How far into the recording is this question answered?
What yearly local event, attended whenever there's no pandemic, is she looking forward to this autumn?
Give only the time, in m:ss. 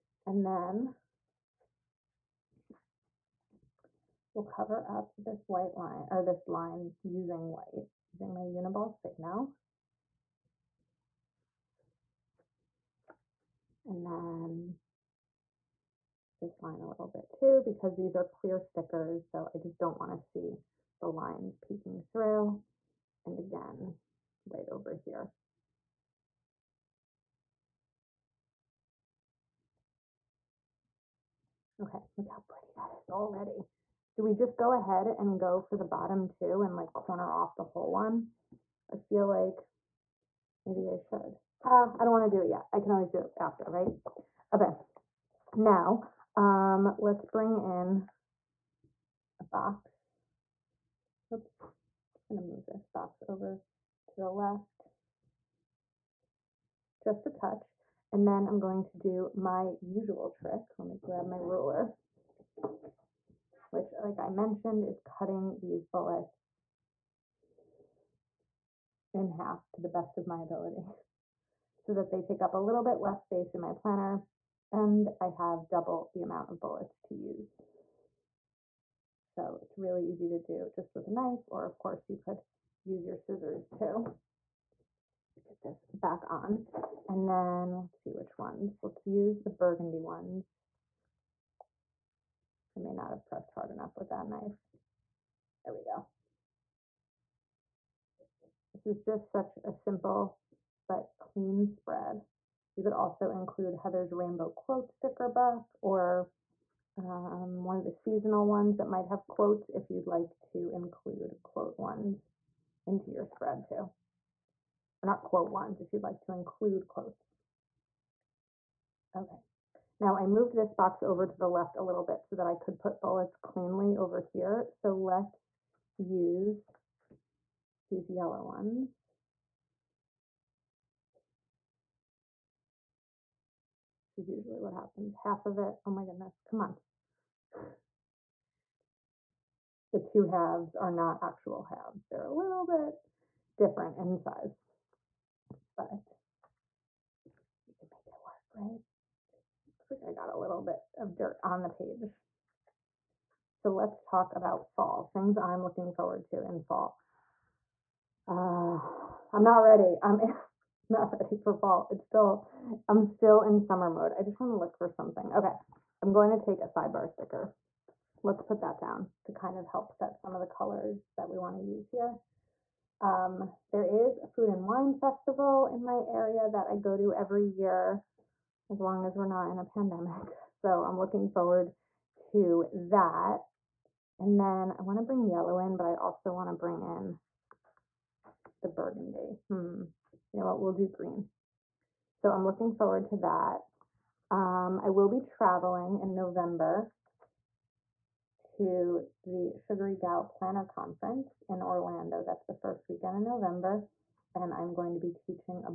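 2:54.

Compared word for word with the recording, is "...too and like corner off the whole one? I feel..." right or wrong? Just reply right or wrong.
right.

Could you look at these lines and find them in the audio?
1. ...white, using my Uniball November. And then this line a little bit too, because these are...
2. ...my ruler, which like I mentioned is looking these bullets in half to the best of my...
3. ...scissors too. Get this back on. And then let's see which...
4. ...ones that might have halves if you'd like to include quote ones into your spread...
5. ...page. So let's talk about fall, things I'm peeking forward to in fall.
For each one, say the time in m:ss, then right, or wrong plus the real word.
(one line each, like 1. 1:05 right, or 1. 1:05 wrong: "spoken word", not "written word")
1. 0:07 wrong: "Signo", not "November"
2. 1:01 wrong: "cutting", not "looking"
3. 1:23 right
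4. 1:48 wrong: "quotes", not "halves"
5. 2:31 wrong: "looking", not "peeking".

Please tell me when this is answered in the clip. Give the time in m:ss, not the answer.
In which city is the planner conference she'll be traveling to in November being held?
3:21.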